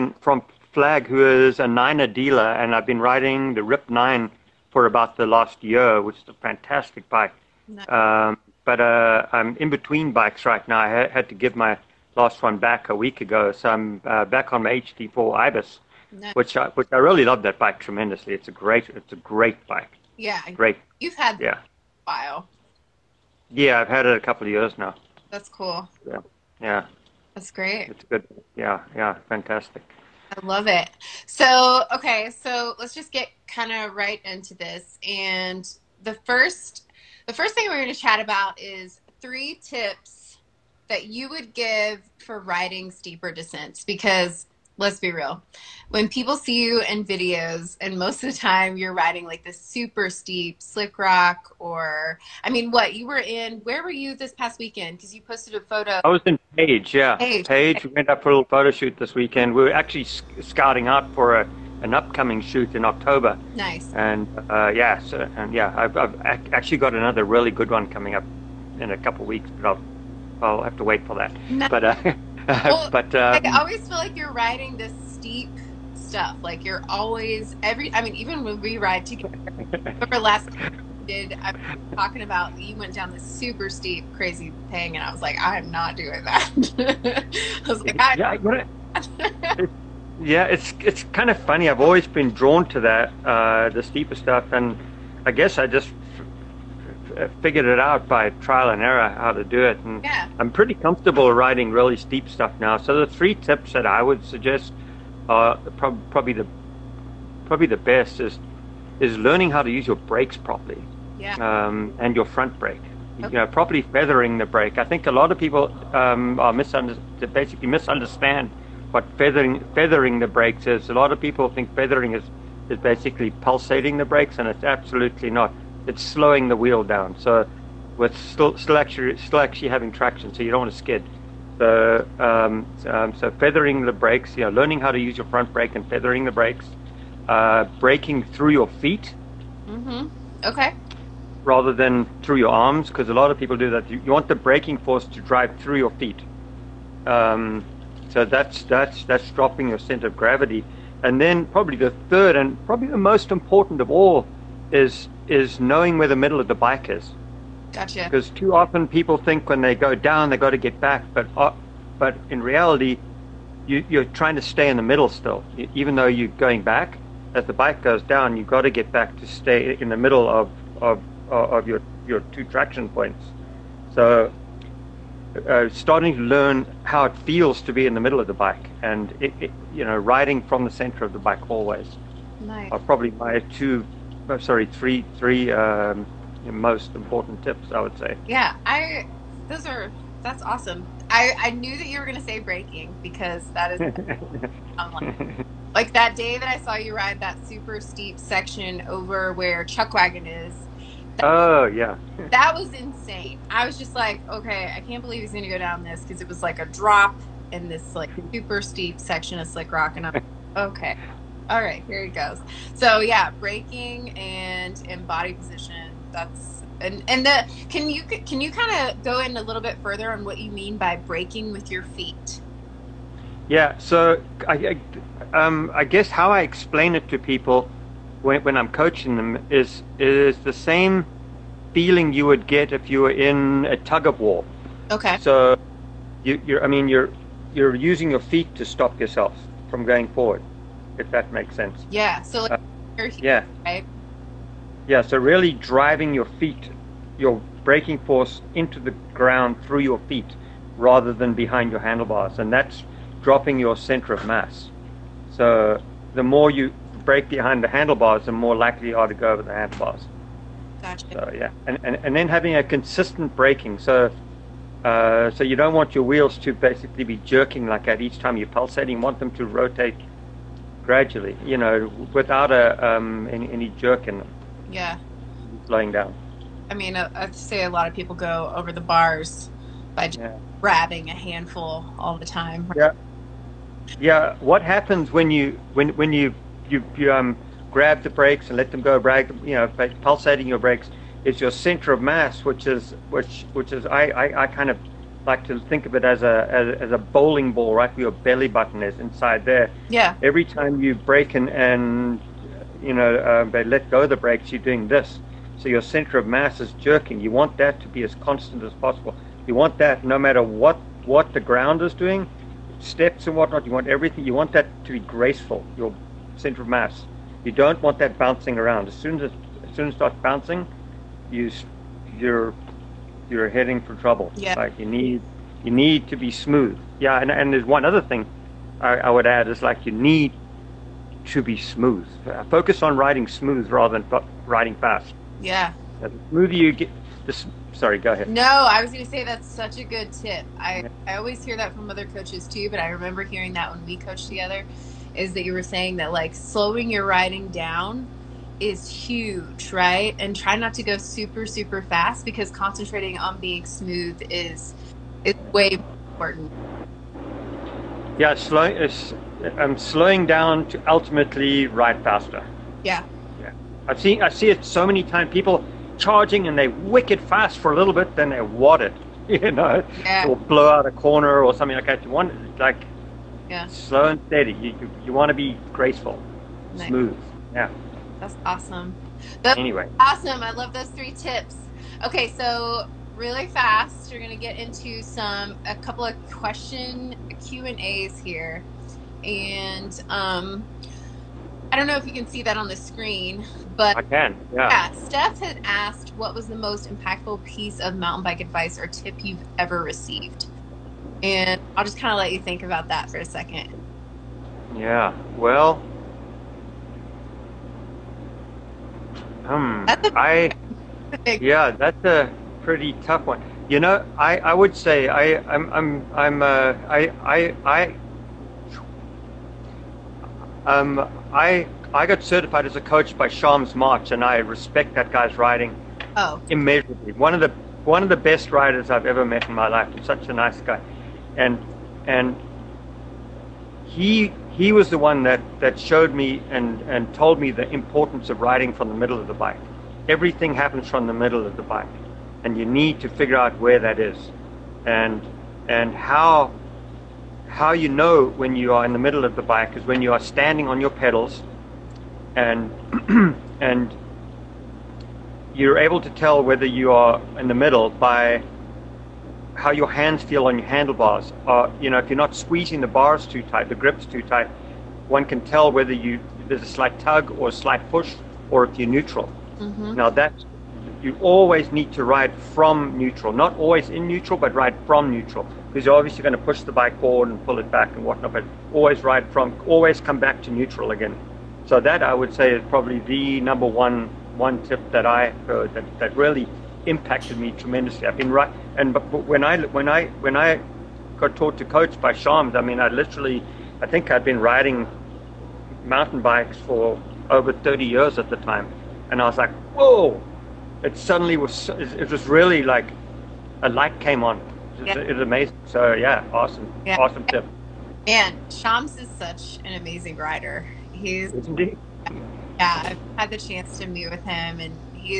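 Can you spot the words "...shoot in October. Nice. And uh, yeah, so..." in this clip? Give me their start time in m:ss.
1:02.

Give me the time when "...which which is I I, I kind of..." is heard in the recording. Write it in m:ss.
4:53.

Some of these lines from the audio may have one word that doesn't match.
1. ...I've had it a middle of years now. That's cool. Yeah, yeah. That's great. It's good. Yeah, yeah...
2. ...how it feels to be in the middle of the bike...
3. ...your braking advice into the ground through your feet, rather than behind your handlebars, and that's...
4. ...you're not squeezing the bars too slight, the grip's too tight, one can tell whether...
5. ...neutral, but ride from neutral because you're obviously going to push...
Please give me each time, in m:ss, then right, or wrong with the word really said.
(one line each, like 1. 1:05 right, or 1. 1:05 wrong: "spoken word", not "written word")
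1. 0:23 wrong: "couple", not "middle"
2. 2:56 right
3. 4:07 wrong: "force", not "advice"
4. 7:42 wrong: "tight", not "slight"
5. 7:54 right.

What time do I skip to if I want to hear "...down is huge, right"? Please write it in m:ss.
5:47.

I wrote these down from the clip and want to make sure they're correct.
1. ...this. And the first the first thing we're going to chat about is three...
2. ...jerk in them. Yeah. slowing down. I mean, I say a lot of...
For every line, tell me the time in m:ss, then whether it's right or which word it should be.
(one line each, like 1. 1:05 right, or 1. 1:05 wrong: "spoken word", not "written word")
1. 0:34 right
2. 4:33 right.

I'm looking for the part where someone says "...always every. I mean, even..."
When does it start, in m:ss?
1:16.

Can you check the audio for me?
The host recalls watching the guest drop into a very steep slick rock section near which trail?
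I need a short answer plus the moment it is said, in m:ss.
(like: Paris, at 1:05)
Chuckwagon, at 3:19.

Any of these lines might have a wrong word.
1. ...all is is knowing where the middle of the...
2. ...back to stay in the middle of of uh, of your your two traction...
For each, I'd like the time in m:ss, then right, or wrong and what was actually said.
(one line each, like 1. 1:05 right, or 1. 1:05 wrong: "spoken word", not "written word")
1. 2:33 right
2. 2:48 right.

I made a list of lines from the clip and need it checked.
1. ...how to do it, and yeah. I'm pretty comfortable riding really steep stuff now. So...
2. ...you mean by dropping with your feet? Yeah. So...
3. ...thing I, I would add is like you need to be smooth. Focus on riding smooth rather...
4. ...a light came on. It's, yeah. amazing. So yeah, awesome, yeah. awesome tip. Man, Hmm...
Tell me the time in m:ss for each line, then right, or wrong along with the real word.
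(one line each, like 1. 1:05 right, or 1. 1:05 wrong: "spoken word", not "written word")
1. 1:39 right
2. 3:40 wrong: "braking", not "dropping"
3. 5:28 right
4. 8:23 wrong: "Shams", not "Hmm".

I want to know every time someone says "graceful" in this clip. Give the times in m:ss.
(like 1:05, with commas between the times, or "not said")
5:14, 6:15.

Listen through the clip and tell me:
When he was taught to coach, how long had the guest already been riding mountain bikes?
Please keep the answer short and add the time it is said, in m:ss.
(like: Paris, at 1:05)
Over 30 years, at 8:17.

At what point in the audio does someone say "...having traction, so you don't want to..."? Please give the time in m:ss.
2:09.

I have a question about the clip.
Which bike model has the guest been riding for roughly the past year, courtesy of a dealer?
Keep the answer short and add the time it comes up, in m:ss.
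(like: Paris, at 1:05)
Rip Nine, at 0:03.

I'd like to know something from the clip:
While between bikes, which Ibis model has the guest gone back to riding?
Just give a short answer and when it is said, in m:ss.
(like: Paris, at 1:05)
HD4, at 0:14.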